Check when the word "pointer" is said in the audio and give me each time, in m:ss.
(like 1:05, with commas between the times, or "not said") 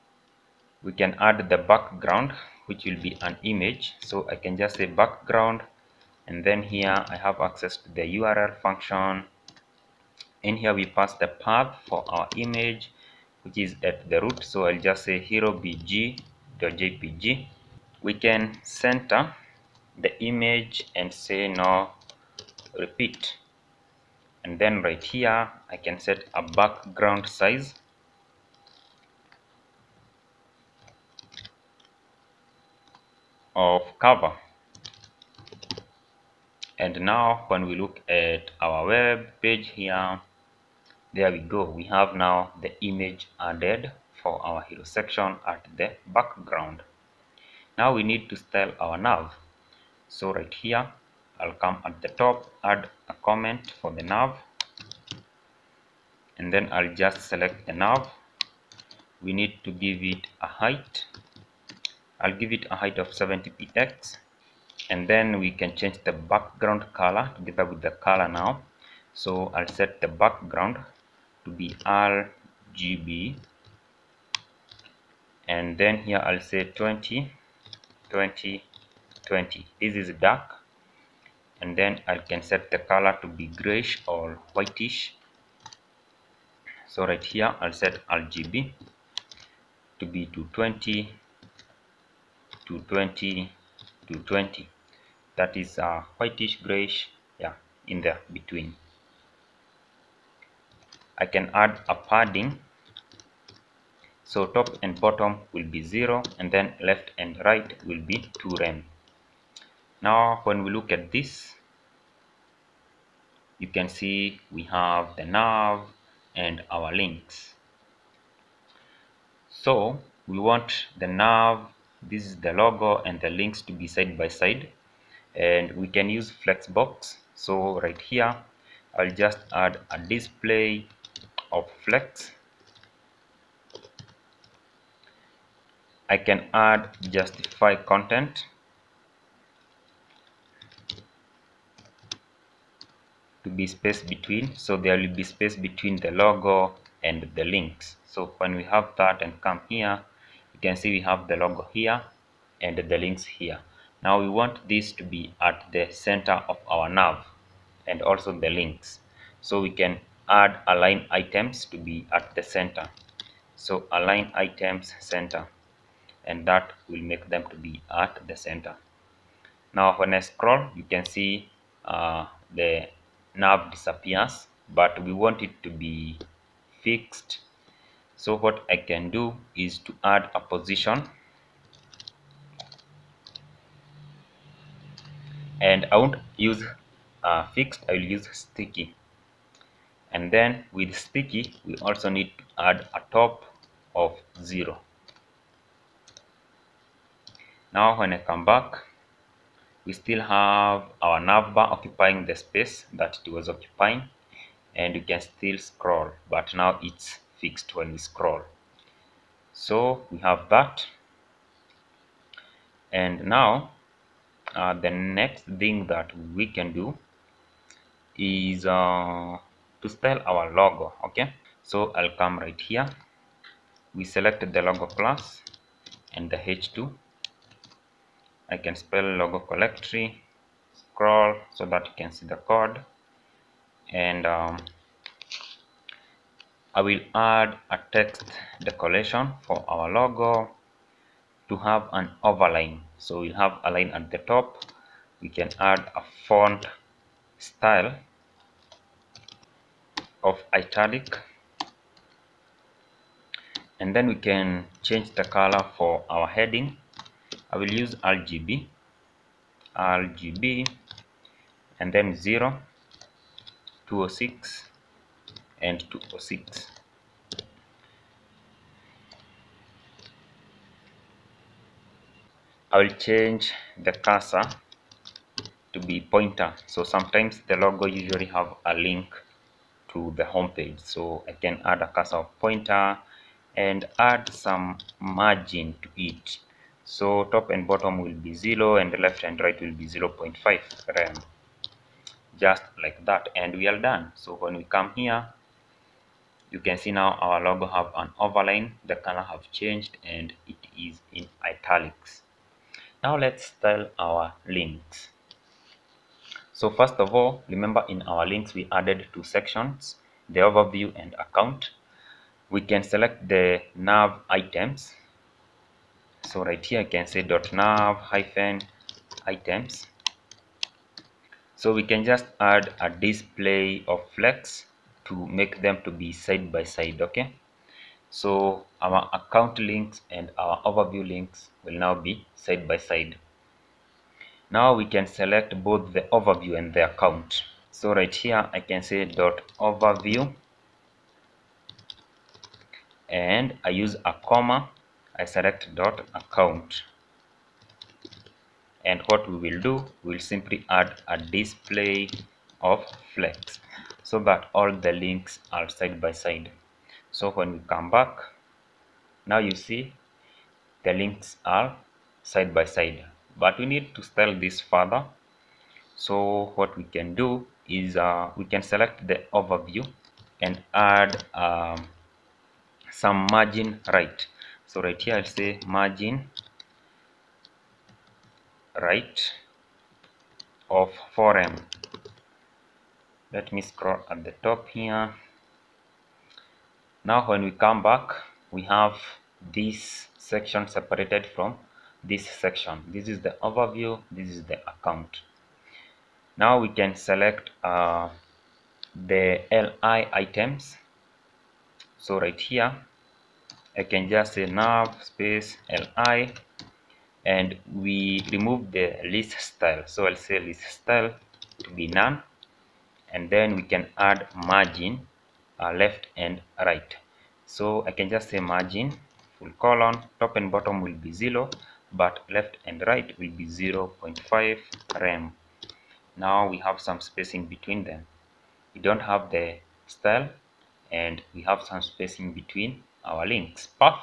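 4:36, 4:42.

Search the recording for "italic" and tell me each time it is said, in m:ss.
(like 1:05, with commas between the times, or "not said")
4:10, 5:01.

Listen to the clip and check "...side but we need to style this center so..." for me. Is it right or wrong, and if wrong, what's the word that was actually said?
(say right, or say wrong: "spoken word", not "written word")
wrong: "further", not "center".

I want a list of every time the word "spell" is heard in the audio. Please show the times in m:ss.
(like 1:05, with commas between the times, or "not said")
3:39, 3:48.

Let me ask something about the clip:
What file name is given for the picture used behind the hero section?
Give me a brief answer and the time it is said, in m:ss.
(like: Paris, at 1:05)
hero bg.jpg, at 0:15.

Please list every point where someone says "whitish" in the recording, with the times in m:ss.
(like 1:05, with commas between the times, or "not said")
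1:24, 1:36.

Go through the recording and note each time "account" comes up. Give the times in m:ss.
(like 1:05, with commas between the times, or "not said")
5:11, 5:29, 5:36, 5:46, 6:34.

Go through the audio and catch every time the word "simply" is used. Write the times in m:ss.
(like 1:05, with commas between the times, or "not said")
5:50.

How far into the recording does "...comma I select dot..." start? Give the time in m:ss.
5:44.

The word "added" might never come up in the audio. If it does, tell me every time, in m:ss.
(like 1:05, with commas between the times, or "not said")
0:43, 5:08.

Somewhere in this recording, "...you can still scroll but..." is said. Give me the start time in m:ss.
3:24.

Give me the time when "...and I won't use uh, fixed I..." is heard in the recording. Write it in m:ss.
3:05.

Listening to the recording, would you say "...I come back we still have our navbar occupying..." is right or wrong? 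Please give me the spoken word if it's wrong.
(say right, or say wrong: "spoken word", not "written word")
right.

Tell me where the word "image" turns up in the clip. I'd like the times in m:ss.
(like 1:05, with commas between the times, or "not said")
0:03, 0:12, 0:20, 0:42.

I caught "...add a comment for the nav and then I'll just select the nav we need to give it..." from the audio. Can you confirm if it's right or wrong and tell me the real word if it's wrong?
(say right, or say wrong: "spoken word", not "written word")
right.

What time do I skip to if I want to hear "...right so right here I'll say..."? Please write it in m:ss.
6:13.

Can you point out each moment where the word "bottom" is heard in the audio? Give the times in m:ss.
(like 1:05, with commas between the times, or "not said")
1:45, 4:47, 7:00.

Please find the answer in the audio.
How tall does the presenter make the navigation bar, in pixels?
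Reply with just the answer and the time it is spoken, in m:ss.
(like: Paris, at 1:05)
70, at 1:03.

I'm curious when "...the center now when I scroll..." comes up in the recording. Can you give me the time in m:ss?
2:48.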